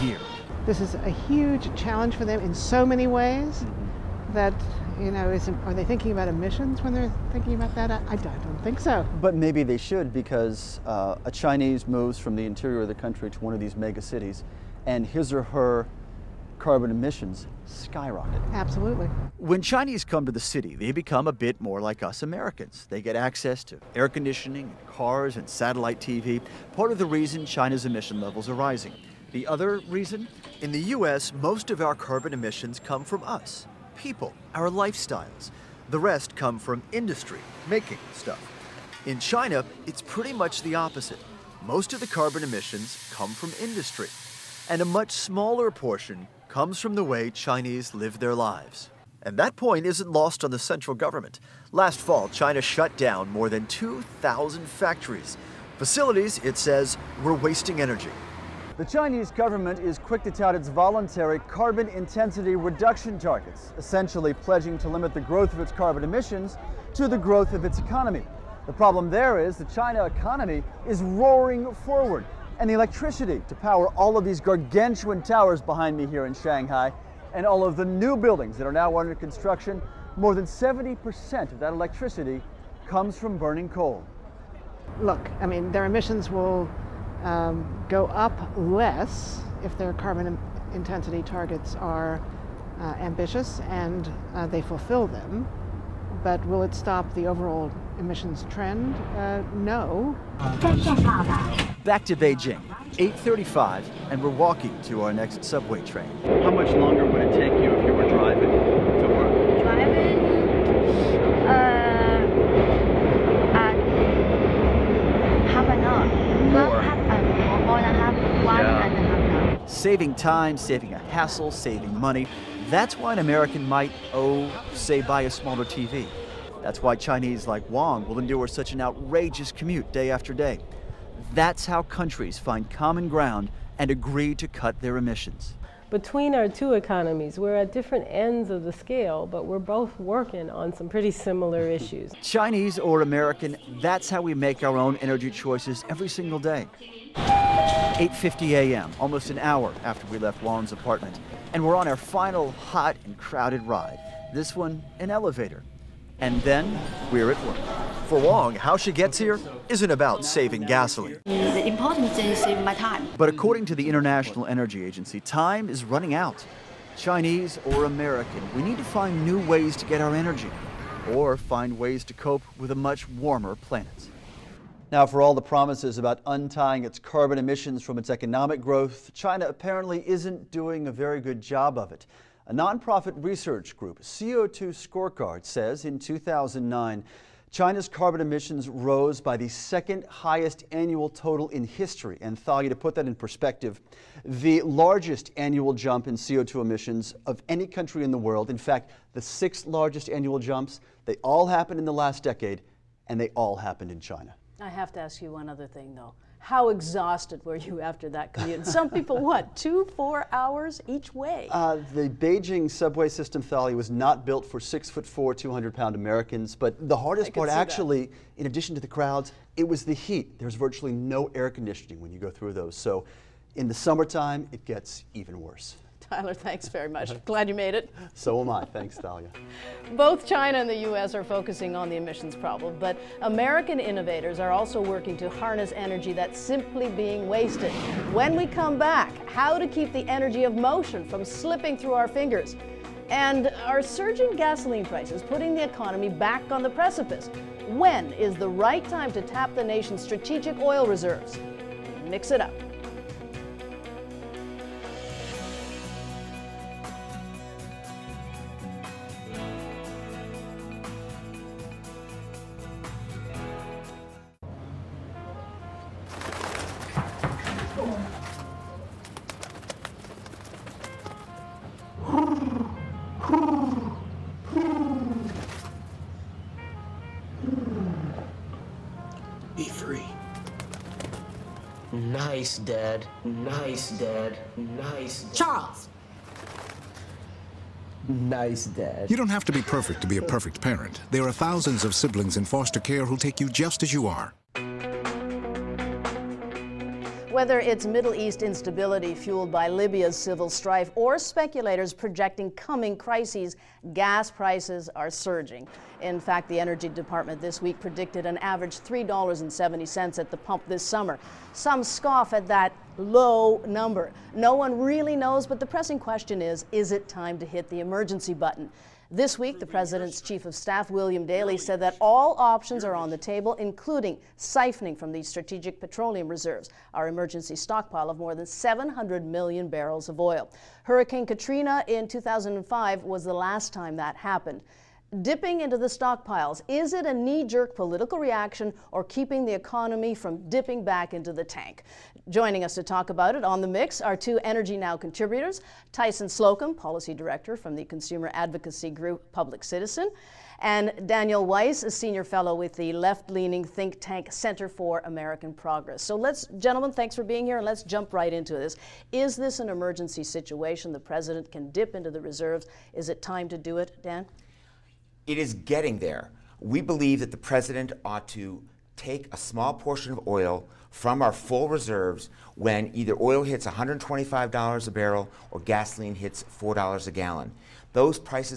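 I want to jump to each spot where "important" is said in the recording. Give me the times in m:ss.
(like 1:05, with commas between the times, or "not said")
2:41.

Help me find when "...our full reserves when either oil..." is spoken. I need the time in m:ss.
6:11.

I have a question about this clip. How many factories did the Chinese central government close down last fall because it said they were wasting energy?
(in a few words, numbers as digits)
More than 2,000.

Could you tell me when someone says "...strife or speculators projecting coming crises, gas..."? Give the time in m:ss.
5:00.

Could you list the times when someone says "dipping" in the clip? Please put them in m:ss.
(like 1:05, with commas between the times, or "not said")
5:35, 5:40.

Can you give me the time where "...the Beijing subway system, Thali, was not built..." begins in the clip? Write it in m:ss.
3:31.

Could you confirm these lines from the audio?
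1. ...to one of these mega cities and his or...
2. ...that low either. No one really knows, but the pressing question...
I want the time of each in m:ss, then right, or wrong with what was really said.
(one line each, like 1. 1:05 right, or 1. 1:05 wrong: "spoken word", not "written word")
1. 0:13 right
2. 5:12 wrong: "number", not "either".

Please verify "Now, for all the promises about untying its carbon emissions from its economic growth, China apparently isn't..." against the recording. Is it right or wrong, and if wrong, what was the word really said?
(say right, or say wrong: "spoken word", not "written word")
right.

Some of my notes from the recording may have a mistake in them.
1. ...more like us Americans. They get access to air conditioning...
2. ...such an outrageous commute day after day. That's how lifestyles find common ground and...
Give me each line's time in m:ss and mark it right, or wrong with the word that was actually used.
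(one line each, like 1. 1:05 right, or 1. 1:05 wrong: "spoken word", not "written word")
1. 0:21 right
2. 2:08 wrong: "countries", not "lifestyles".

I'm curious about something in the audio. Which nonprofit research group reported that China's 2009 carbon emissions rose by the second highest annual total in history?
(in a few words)
CO2 Scorecard.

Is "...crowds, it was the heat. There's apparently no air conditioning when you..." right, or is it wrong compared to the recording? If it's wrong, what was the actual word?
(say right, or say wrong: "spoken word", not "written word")
wrong: "virtually", not "apparently".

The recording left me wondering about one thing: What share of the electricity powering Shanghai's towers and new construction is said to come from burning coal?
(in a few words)
More than 70%.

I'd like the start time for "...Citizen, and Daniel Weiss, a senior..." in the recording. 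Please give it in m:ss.
5:49.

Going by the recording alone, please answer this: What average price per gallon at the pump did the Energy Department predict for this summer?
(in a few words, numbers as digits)
$3.70.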